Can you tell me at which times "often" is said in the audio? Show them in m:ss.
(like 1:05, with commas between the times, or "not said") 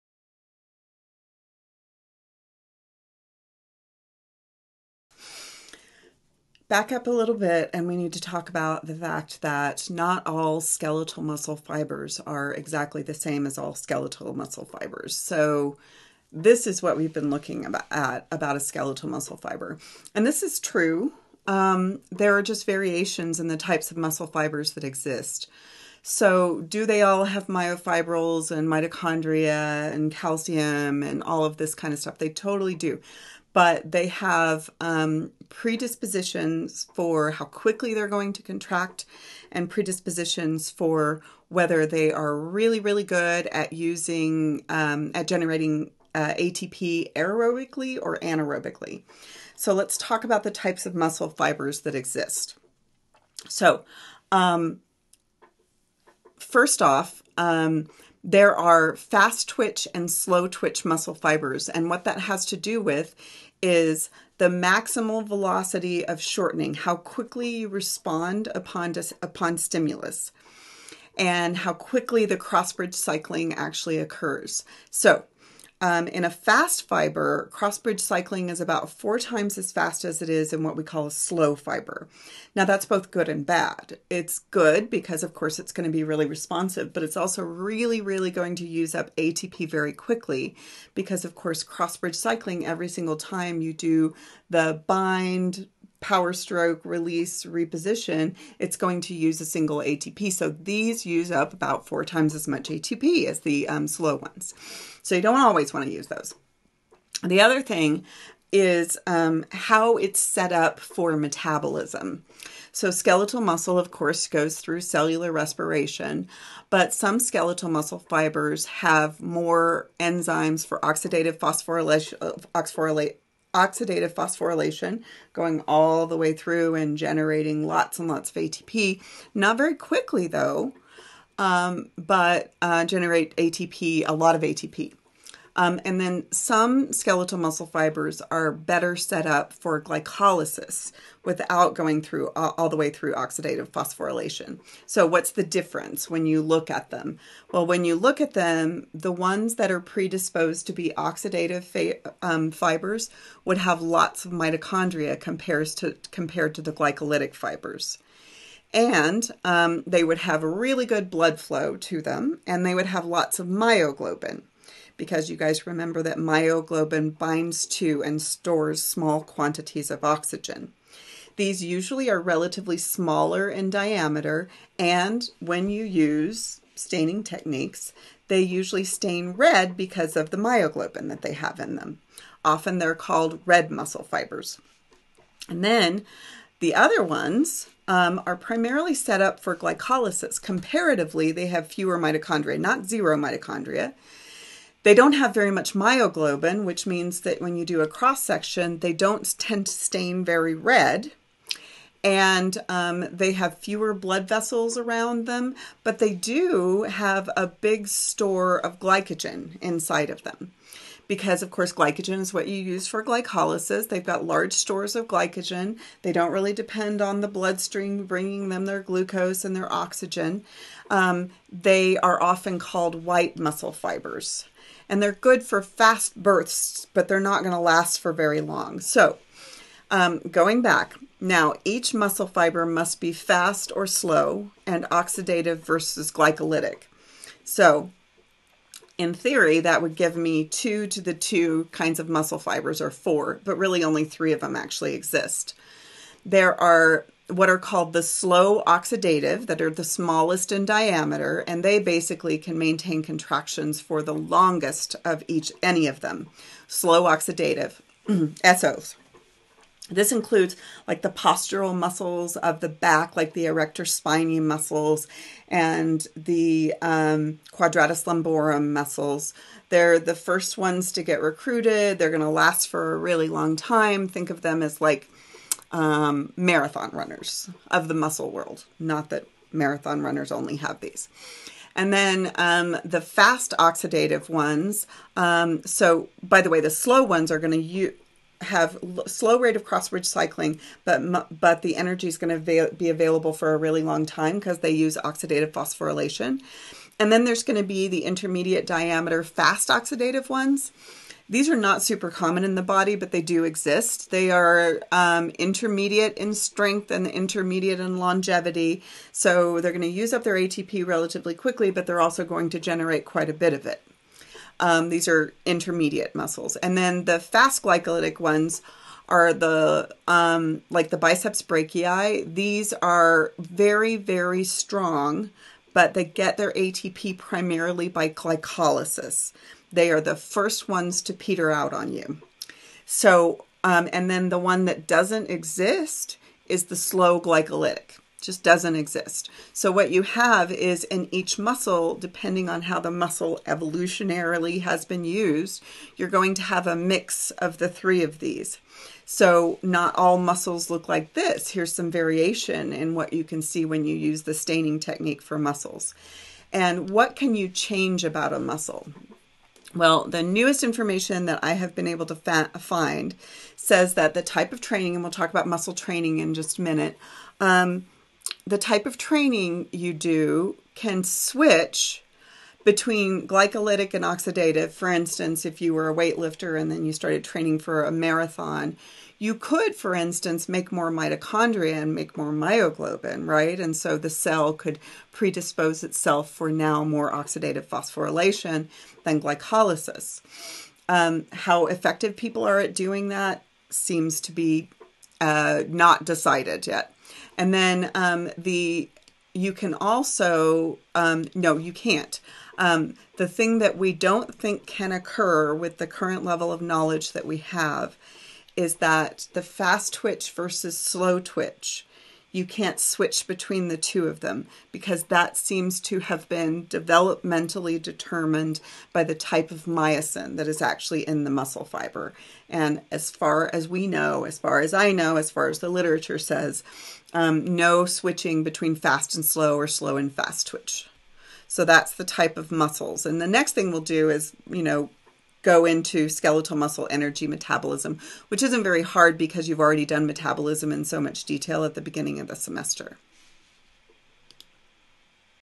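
3:02, 3:42.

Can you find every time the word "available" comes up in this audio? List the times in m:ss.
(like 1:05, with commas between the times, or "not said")
4:52.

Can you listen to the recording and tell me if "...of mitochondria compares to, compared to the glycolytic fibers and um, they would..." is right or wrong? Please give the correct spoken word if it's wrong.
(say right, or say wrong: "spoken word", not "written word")
right.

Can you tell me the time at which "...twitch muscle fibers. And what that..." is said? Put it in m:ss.
1:00.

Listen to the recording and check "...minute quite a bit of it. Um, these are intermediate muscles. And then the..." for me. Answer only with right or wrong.
wrong.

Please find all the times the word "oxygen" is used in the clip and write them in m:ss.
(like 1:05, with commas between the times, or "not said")
2:50, 3:39.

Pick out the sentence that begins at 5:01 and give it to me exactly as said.
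These are not super common in the body, but they do exist.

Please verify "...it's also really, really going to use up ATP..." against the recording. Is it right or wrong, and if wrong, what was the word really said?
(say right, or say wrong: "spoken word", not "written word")
right.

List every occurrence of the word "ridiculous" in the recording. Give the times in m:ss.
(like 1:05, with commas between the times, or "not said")
not said.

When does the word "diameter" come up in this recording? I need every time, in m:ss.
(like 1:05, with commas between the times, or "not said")
2:53, 4:10, 4:58.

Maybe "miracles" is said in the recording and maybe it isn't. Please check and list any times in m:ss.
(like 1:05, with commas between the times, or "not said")
not said.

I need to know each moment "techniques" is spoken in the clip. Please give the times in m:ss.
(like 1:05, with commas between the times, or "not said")
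2:57, 5:54.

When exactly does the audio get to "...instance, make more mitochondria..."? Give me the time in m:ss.
6:19.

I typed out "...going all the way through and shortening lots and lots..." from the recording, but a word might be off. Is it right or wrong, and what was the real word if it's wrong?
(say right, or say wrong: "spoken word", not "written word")
wrong: "generating", not "shortening".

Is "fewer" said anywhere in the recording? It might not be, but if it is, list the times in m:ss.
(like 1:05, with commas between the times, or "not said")
3:11, 3:23.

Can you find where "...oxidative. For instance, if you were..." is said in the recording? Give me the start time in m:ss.
6:14.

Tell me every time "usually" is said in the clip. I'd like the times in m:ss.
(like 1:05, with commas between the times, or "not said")
2:51, 2:58.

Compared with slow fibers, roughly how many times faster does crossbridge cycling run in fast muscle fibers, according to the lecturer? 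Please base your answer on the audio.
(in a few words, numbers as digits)
4 times.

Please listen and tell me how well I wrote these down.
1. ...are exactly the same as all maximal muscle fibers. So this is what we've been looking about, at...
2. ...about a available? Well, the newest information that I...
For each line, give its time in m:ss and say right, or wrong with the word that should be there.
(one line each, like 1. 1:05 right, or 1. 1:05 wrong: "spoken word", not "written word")
1. 0:12 wrong: "skeletal", not "maximal"
2. 5:58 wrong: "muscle", not "available".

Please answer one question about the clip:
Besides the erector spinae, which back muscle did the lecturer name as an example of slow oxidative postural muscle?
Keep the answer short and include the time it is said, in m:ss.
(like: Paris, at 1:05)
Quadratus lumborum, at 4:27.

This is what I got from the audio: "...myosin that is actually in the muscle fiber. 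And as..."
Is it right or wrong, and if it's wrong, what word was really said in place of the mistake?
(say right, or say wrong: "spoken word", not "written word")
right.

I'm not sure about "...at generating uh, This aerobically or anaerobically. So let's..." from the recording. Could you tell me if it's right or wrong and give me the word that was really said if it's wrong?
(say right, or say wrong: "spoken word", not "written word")
wrong: "ATP", not "This".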